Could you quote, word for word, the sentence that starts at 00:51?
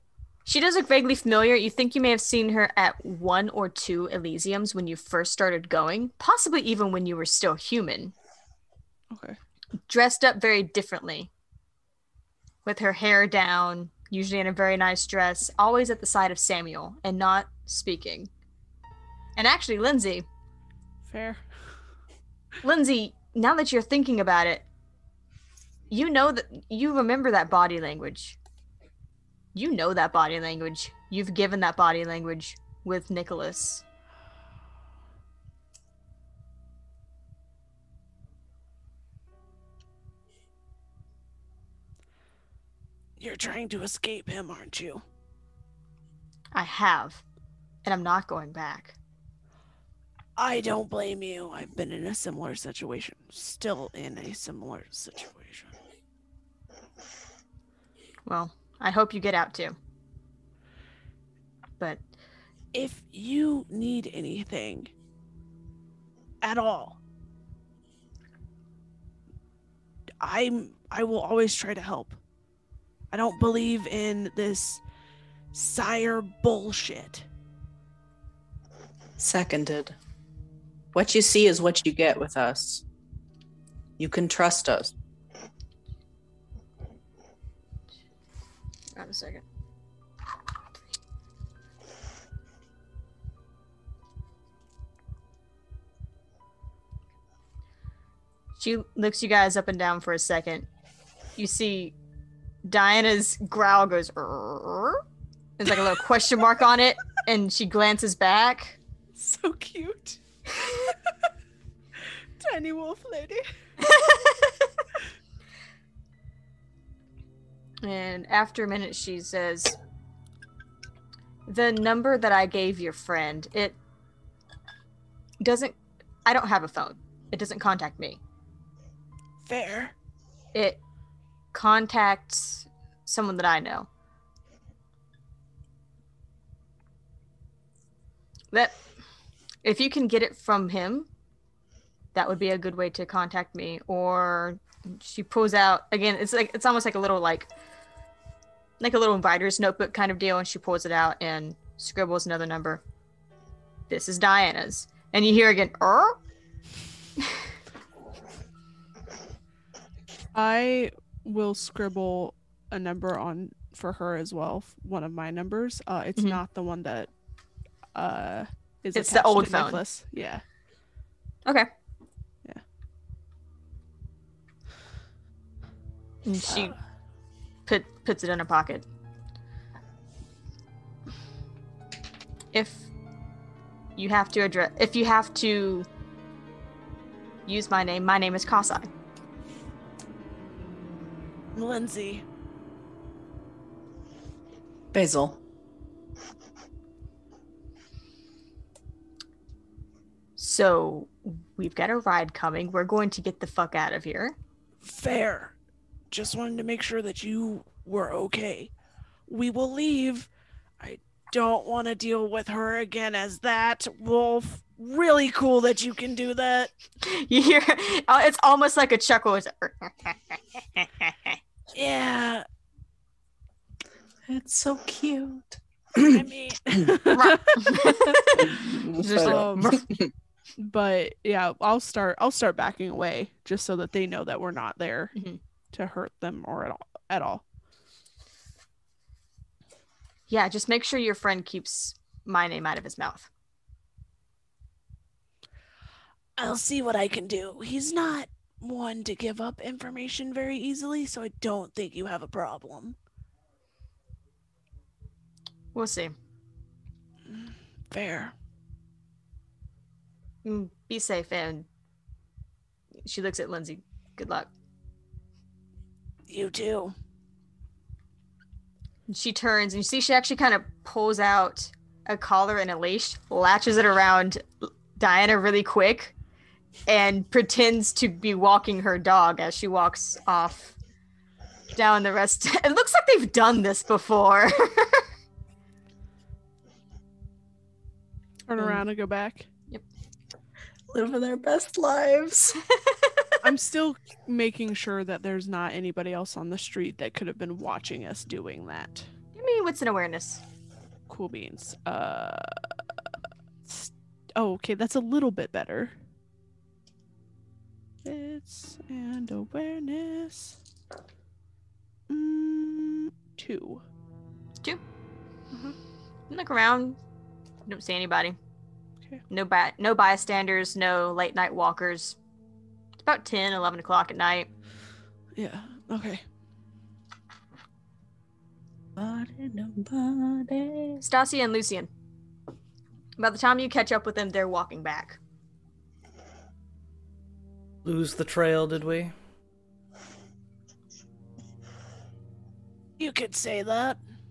I've been in a similar situation, still in a similar situation.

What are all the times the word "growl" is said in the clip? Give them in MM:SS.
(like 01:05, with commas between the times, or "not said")
01:43.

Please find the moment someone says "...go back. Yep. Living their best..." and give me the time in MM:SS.
04:48.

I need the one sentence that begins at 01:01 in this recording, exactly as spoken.
But if you need anything at all, I'm I will always try to help.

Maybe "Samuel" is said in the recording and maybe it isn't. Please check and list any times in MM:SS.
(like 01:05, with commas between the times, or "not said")
00:16.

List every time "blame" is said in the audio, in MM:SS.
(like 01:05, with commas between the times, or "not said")
00:50.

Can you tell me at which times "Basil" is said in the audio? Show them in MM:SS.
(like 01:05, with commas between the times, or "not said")
03:14.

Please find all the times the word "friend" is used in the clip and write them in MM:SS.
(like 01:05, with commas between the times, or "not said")
02:02, 04:01.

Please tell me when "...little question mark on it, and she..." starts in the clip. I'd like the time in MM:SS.
01:45.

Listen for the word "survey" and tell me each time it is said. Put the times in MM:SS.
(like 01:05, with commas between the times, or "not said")
not said.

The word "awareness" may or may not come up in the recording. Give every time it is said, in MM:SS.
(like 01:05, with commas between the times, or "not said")
04:59, 05:09.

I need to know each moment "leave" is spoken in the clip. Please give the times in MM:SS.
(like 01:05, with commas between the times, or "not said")
03:29.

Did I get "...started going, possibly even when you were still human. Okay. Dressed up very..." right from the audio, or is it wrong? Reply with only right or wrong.
right.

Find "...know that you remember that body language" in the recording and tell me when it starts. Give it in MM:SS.
00:26.